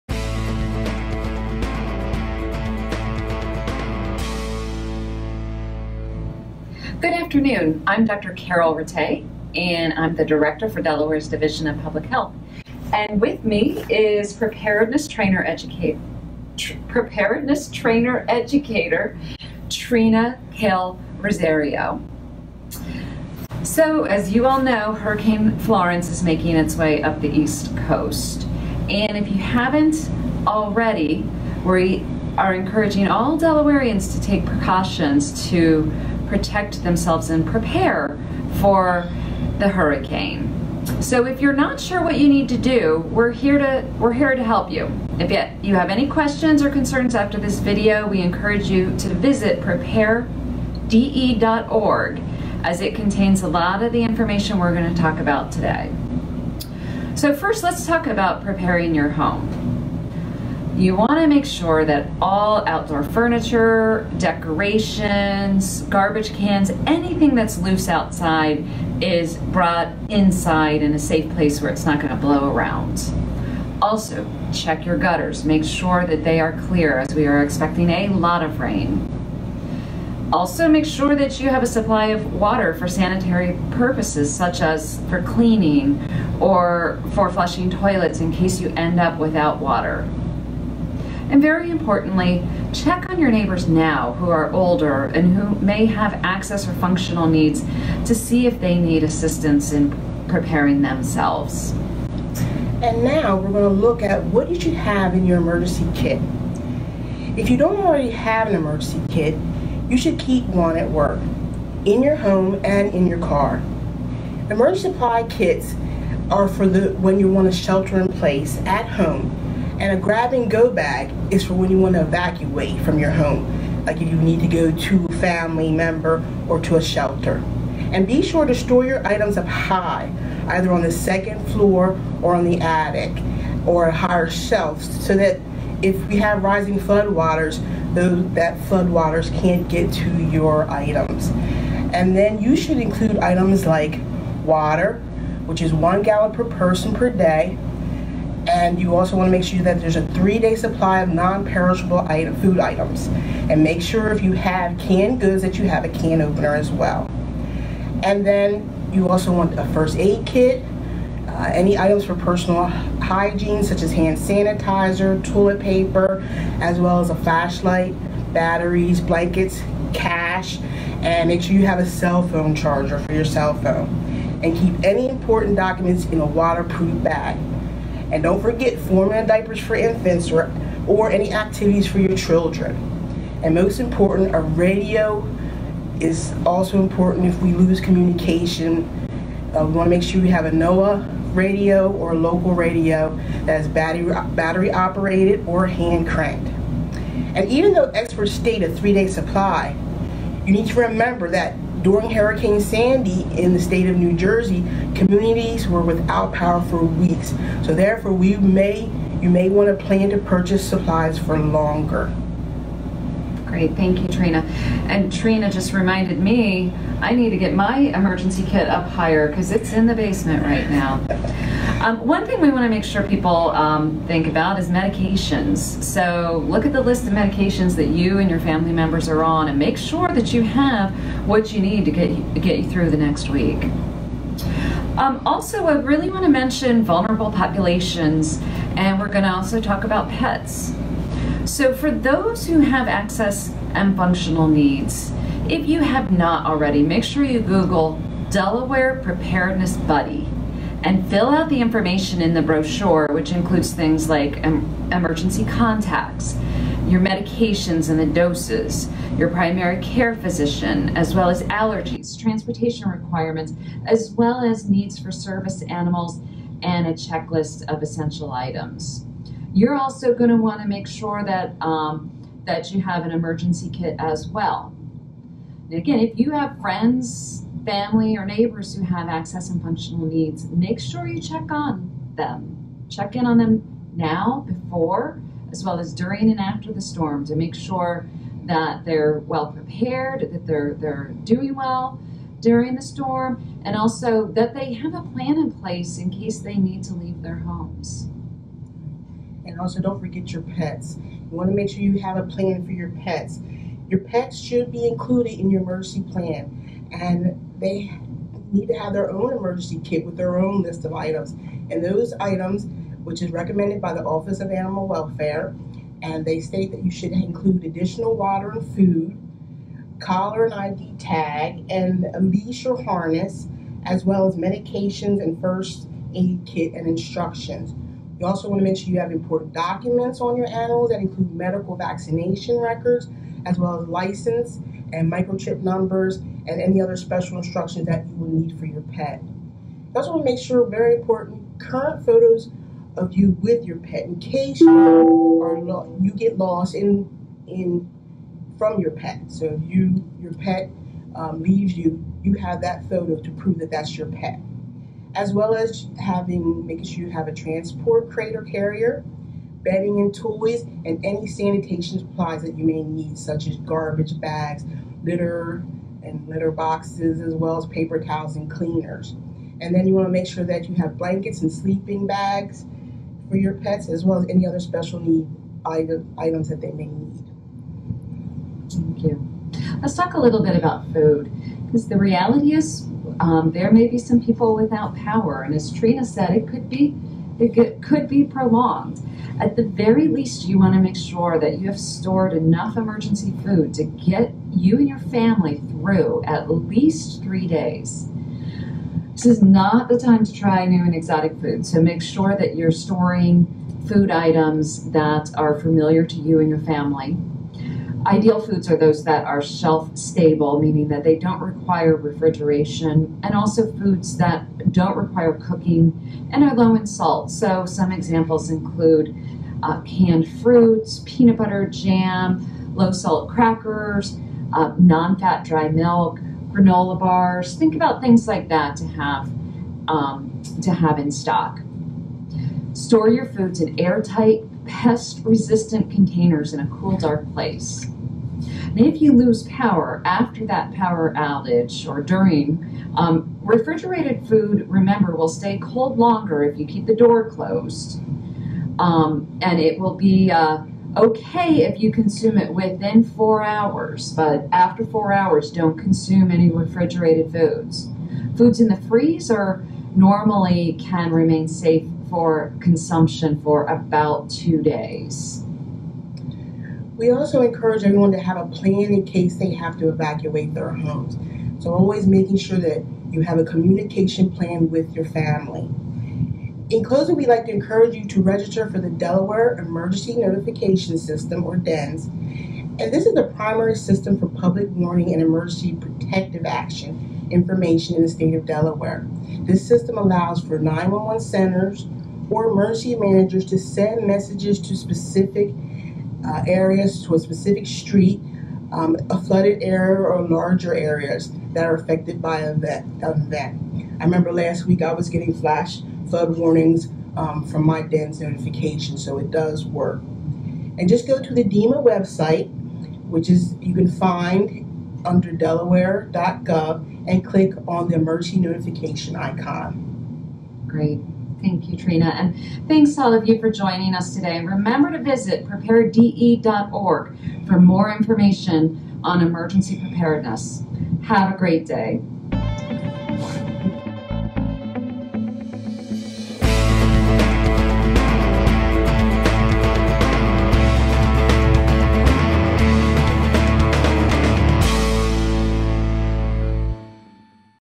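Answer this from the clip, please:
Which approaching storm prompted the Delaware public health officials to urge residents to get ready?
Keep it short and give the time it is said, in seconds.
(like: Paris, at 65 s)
Hurricane Florence, at 24 s.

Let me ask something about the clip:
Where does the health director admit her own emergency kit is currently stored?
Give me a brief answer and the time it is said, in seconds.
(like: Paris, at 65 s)
the basement, at 219 s.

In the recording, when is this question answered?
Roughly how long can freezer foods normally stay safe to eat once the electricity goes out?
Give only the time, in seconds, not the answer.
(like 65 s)
463 s.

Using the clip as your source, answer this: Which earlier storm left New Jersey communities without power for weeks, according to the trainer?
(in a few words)
Hurricane Sandy.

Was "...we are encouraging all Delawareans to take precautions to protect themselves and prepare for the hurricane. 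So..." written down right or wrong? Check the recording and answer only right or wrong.
right.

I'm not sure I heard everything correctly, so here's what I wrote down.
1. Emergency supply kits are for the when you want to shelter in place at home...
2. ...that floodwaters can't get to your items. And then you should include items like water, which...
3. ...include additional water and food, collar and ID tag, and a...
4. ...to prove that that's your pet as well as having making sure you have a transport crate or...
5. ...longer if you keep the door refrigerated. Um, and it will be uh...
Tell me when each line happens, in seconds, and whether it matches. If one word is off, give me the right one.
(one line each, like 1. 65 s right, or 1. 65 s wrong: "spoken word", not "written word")
1. 114 s right
2. 138 s right
3. 317 s right
4. 353 s right
5. 445 s wrong: "closed", not "refrigerated".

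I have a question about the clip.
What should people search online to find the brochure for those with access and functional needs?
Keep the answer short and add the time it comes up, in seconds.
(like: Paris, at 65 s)
Delaware Preparedness Buddy, at 248 s.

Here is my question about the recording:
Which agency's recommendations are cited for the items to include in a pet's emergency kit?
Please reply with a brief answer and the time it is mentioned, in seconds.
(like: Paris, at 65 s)
Office of Animal Welfare, at 314 s.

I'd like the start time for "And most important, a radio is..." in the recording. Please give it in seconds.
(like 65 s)
183 s.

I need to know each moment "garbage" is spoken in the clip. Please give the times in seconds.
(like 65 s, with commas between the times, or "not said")
65 s, 363 s.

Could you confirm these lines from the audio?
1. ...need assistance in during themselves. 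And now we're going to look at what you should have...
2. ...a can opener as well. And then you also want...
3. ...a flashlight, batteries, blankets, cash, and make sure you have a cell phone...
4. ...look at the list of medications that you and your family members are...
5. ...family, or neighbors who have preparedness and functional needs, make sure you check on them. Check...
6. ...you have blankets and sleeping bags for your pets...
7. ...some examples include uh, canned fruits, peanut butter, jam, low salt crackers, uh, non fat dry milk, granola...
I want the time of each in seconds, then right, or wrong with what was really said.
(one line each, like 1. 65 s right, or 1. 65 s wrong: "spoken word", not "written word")
1. 98 s wrong: "preparing", not "during"
2. 155 s right
3. 167 s right
4. 226 s right
5. 277 s wrong: "access", not "preparedness"
6. 370 s right
7. 417 s right.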